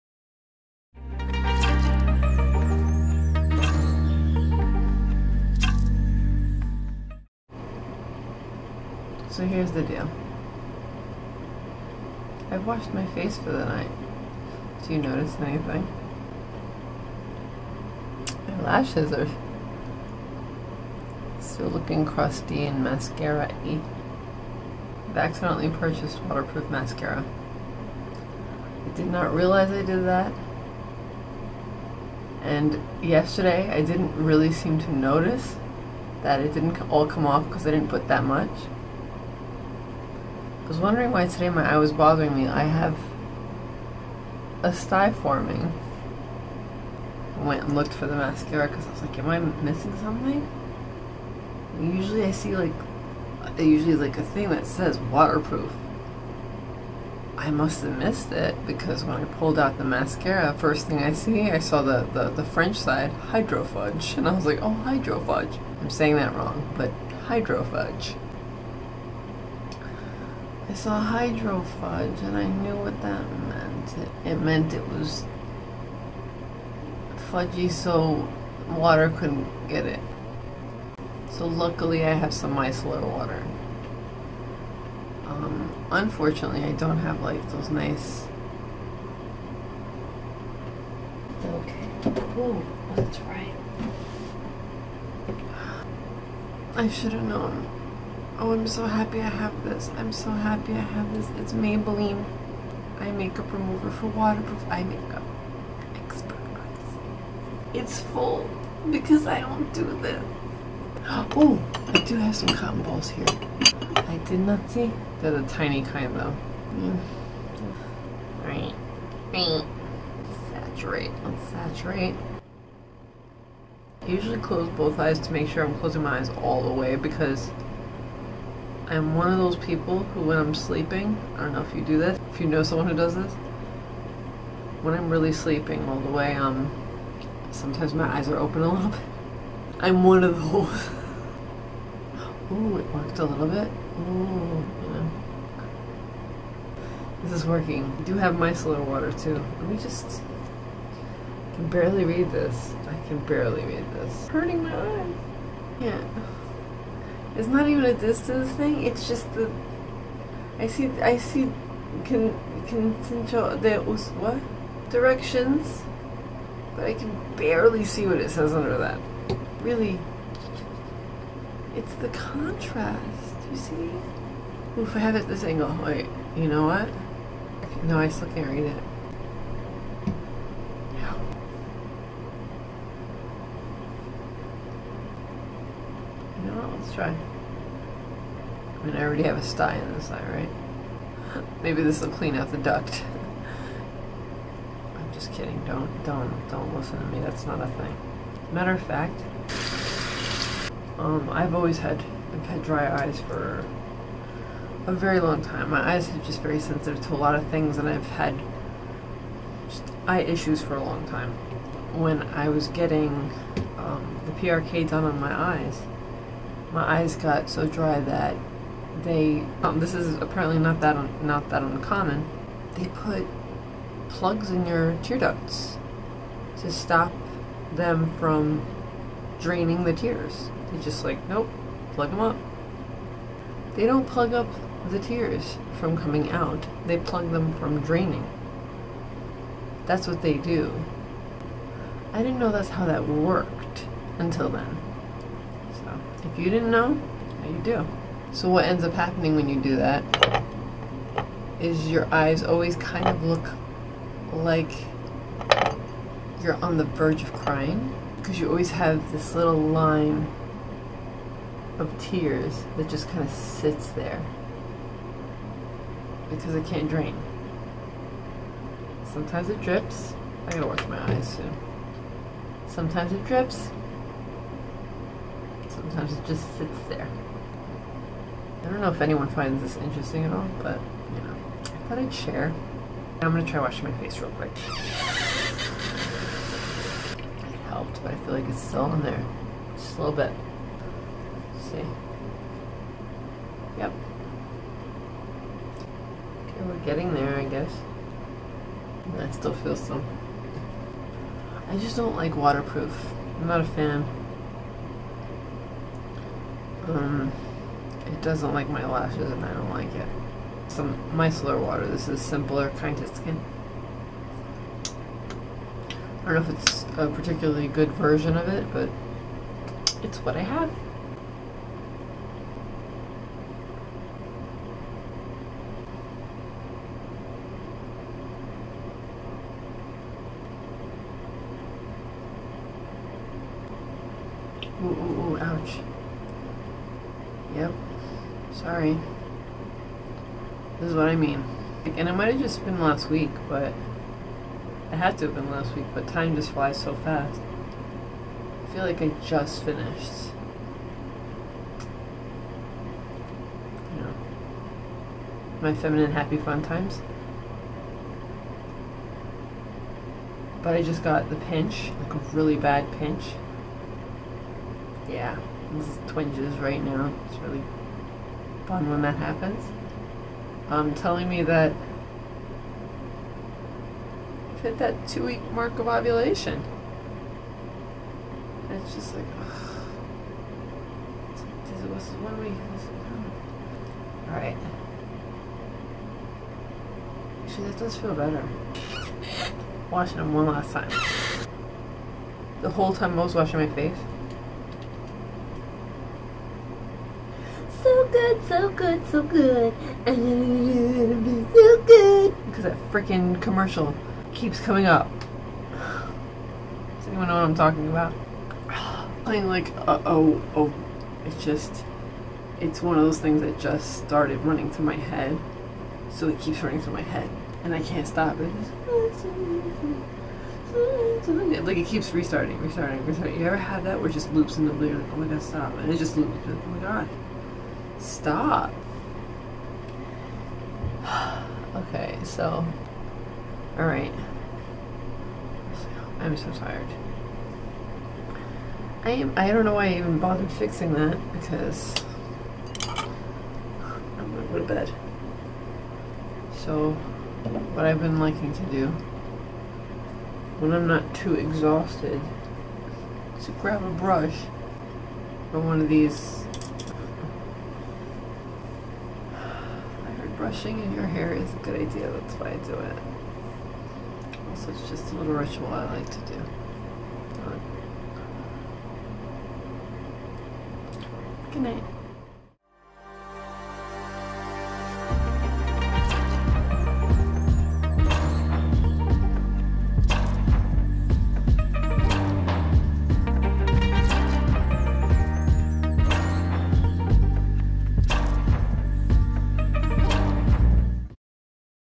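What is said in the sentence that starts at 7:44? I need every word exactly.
Also, it's just a little ritual I like to do.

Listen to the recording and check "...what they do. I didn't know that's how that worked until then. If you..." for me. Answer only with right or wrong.
right.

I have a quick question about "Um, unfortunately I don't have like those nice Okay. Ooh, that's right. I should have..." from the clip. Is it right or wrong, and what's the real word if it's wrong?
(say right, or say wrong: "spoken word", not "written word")
right.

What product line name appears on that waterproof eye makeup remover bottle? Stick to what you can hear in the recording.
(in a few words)
Expert Eyes.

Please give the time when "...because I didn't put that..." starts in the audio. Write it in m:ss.
0:37.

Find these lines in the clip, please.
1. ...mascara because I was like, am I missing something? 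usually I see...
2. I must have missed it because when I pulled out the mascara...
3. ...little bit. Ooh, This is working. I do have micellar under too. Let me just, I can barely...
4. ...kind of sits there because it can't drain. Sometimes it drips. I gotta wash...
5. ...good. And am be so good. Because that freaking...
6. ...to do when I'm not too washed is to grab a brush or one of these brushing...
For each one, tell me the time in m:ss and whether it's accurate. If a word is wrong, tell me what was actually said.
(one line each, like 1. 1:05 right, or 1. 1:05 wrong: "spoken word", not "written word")
1. 0:48 right
2. 0:57 right
3. 2:23 wrong: "water", not "under"
4. 4:23 right
5. 6:39 right
6. 7:28 wrong: "exhausted", not "washed".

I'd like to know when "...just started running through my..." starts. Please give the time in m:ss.
6:53.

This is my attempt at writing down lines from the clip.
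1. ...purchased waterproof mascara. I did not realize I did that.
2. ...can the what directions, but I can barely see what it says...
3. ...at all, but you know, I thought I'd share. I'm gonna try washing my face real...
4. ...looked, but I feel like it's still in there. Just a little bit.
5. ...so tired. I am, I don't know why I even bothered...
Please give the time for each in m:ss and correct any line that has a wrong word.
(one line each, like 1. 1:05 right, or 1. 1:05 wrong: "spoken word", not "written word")
1. 0:25 right
2. 2:42 right
3. 4:40 right
4. 4:47 wrong: "helped", not "looked"
5. 7:16 right.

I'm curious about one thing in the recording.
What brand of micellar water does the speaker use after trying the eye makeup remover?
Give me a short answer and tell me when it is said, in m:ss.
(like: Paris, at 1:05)
Simple, at 5:12.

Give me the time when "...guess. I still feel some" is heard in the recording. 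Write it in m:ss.
4:57.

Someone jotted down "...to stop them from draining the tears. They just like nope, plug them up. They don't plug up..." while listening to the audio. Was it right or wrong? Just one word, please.
right.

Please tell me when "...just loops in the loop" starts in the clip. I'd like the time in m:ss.
7:04.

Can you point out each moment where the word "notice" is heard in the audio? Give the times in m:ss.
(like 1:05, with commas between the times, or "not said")
0:15, 0:34.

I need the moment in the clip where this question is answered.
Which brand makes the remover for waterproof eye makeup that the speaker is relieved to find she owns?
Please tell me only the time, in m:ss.
1:41.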